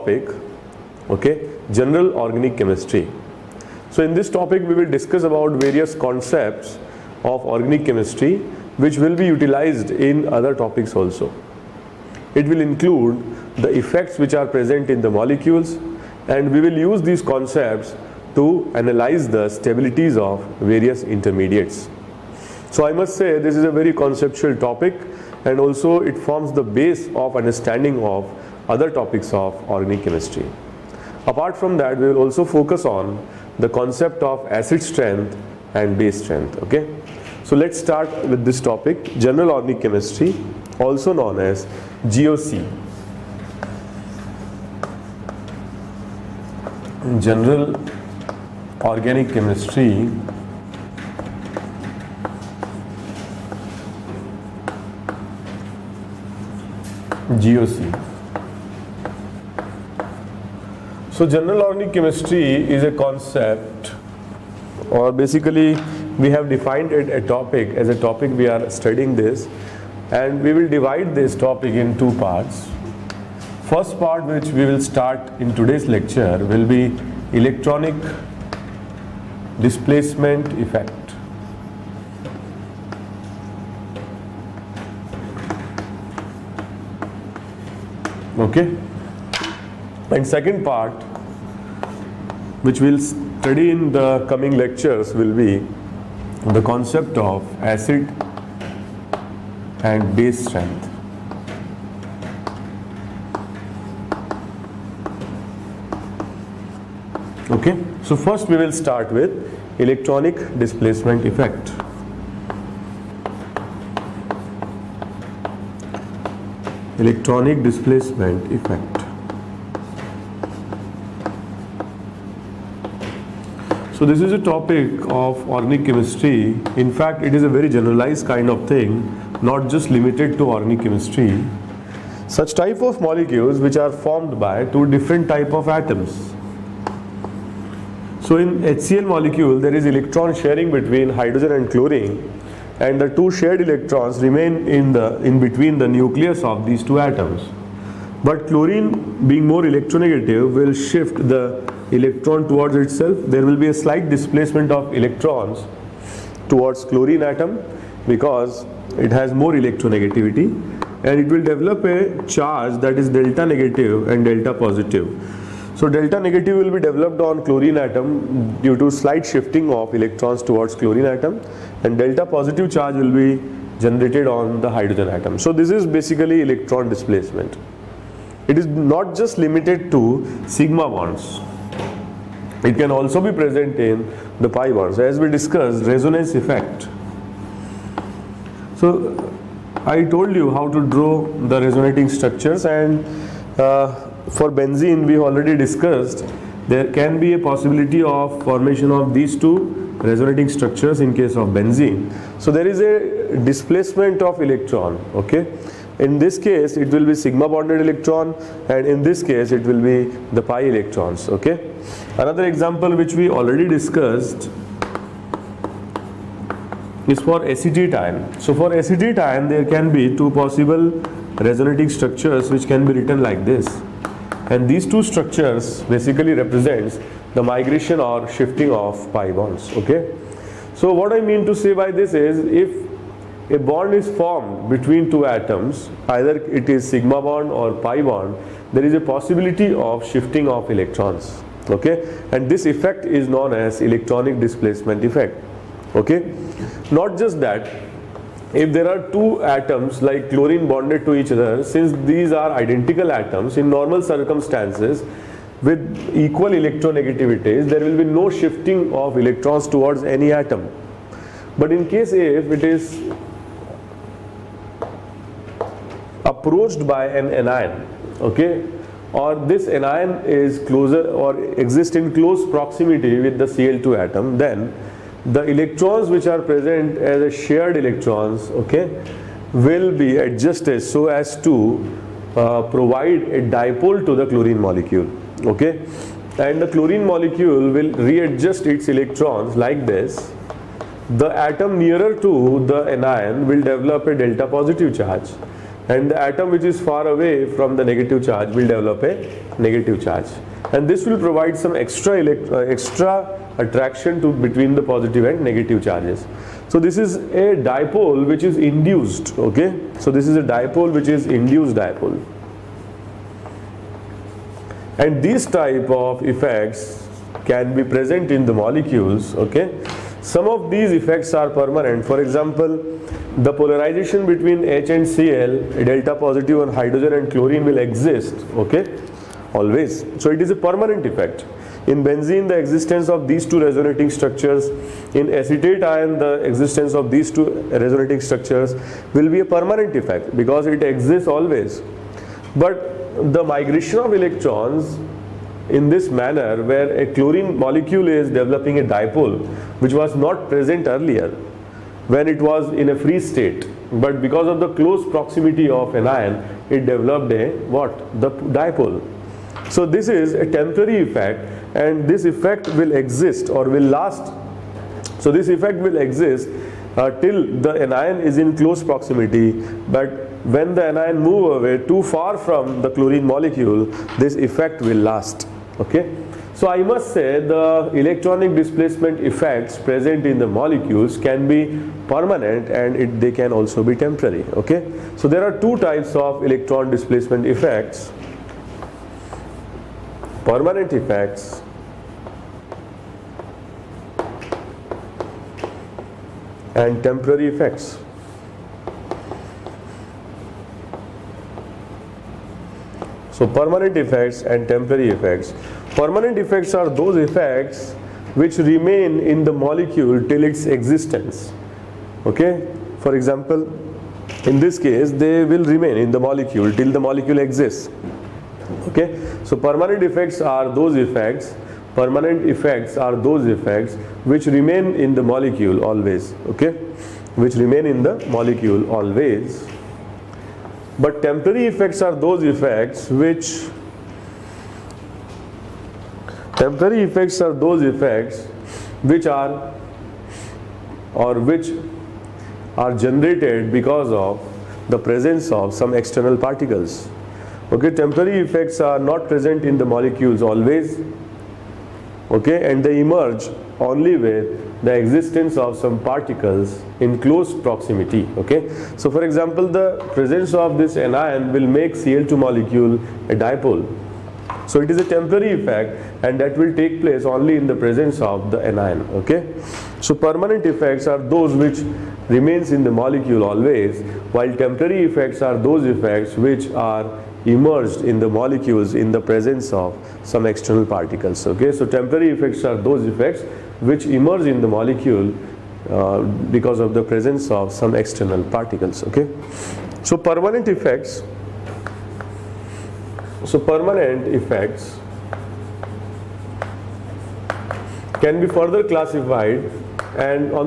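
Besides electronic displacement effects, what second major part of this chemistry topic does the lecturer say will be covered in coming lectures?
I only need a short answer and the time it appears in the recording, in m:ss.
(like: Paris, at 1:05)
acid and base strength, at 1:37.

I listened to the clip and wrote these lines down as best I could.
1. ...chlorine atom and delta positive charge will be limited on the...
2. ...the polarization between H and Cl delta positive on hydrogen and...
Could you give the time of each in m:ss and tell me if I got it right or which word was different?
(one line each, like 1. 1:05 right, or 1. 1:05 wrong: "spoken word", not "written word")
1. 2:50 wrong: "generated", not "limited"
2. 5:23 right.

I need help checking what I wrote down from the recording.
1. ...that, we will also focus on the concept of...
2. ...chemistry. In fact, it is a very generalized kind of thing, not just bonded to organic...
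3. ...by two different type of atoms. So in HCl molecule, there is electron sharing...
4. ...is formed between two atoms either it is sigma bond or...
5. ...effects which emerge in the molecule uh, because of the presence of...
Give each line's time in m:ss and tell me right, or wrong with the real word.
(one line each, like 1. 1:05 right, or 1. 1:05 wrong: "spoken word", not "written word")
1. 0:31 right
2. 2:05 wrong: "limited", not "bonded"
3. 2:14 right
4. 3:53 right
5. 8:03 right.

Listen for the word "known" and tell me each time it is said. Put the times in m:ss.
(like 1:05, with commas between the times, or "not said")
0:41, 4:03.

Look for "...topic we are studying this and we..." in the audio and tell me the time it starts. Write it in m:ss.
1:07.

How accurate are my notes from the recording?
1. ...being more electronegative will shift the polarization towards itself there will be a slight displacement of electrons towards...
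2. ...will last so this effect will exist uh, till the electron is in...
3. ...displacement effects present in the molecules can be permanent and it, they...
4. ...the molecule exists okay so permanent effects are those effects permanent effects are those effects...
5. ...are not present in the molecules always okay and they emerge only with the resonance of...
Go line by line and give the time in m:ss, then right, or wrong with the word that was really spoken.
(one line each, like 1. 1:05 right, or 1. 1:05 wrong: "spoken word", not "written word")
1. 2:29 wrong: "electron", not "polarization"
2. 6:03 wrong: "anion", not "electron"
3. 6:18 right
4. 6:56 right
5. 7:28 wrong: "existence", not "resonance".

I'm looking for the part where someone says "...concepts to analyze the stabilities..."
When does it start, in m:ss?
0:17.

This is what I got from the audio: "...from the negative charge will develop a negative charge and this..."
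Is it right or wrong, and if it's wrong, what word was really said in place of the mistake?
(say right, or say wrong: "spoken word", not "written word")
right.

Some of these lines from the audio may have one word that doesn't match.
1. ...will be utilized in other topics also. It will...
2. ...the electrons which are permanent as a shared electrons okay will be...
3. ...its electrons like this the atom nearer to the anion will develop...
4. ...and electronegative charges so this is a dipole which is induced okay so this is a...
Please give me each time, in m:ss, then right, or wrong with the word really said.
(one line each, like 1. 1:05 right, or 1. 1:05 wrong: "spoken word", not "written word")
1. 0:08 right
2. 4:35 wrong: "present", not "permanent"
3. 4:48 right
4. 5:05 wrong: "negative", not "electronegative".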